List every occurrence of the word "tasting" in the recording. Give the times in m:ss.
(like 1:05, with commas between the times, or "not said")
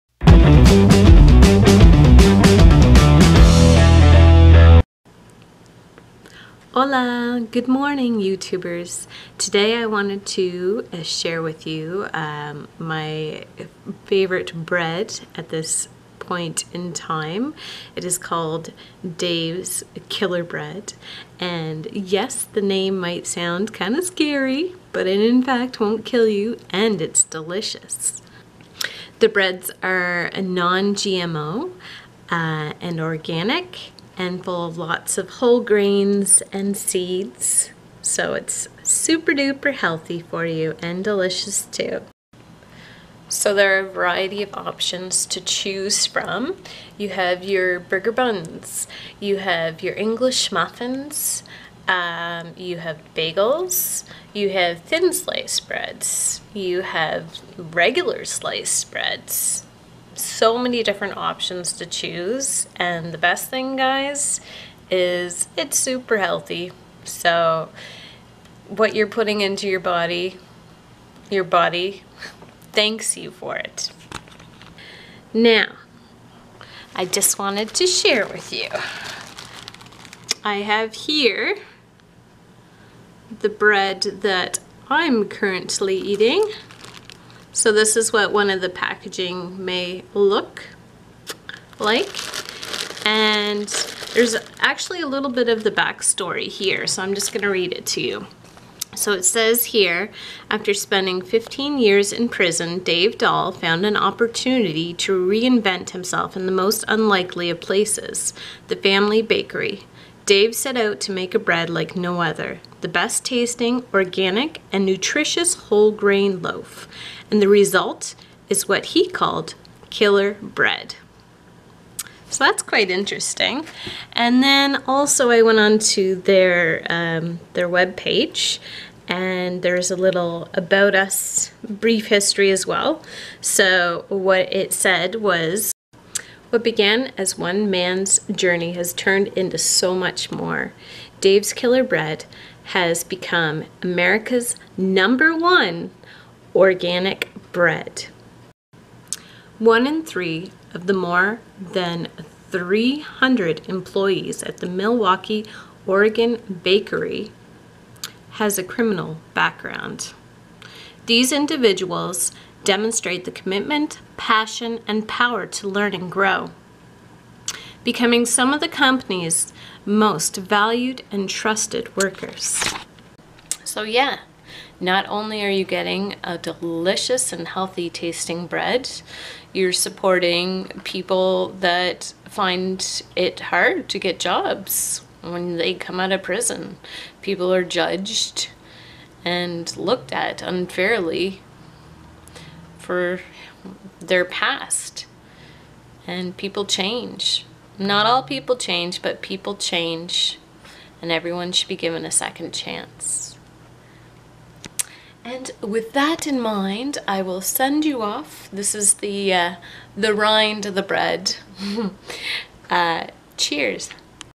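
1:53, 2:57.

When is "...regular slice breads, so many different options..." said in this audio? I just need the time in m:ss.
0:57.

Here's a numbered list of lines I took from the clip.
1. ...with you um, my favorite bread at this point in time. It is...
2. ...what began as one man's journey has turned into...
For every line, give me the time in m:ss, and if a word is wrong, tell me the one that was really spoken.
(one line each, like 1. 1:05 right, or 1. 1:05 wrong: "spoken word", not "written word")
1. 0:11 right
2. 2:16 right.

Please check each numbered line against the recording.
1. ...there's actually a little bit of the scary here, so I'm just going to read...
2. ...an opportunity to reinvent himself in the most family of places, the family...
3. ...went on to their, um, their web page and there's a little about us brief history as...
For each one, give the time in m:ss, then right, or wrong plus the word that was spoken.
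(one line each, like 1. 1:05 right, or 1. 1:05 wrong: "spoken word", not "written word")
1. 1:34 wrong: "backstory", not "scary"
2. 1:43 wrong: "unlikely", not "family"
3. 2:05 right.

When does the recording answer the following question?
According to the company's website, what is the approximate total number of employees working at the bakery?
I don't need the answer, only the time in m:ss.
2:30.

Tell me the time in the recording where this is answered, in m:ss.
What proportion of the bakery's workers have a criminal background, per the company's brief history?
2:29.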